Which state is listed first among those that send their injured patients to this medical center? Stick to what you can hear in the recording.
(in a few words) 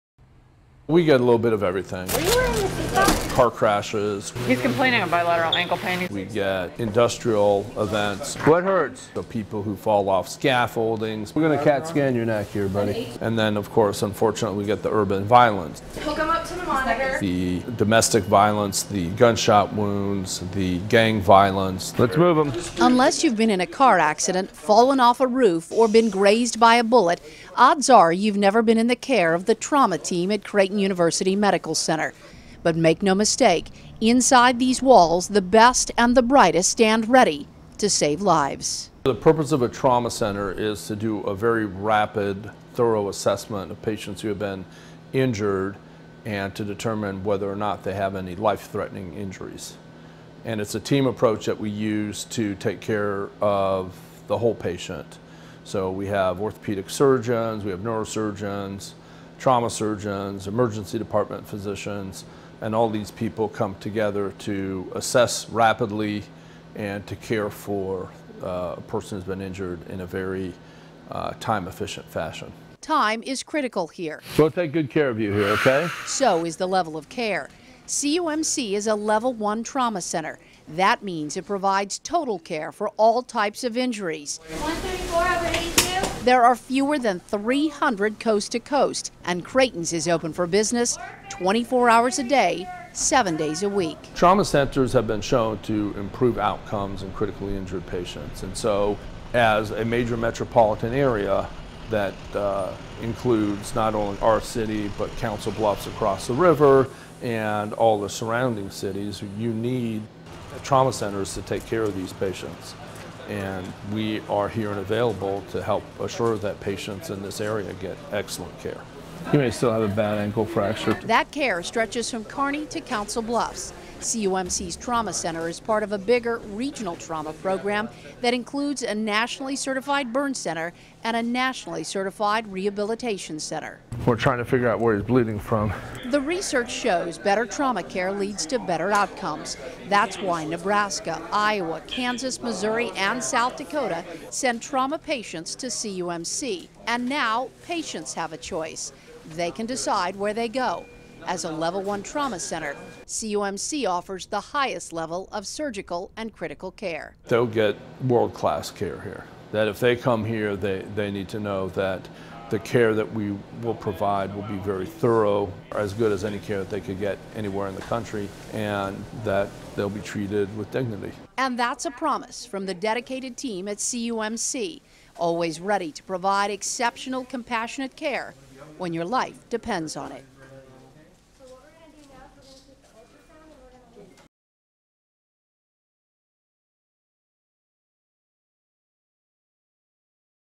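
Nebraska.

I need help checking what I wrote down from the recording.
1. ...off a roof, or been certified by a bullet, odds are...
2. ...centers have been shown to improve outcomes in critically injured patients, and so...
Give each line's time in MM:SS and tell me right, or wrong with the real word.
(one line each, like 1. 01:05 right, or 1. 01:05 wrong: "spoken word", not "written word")
1. 00:24 wrong: "grazed", not "certified"
2. 01:34 right.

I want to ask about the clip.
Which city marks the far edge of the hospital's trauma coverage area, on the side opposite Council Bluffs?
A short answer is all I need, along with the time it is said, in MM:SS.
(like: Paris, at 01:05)
Kearney, at 02:02.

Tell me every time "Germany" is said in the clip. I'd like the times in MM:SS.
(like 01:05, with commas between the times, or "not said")
not said.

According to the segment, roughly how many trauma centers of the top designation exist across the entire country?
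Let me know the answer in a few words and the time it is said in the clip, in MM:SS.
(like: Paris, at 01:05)
fewer than 300, at 01:26.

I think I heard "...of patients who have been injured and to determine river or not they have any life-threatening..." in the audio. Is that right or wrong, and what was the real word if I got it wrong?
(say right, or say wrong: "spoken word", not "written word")
wrong: "whether", not "river".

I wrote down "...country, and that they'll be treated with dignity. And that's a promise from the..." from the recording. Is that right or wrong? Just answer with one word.
right.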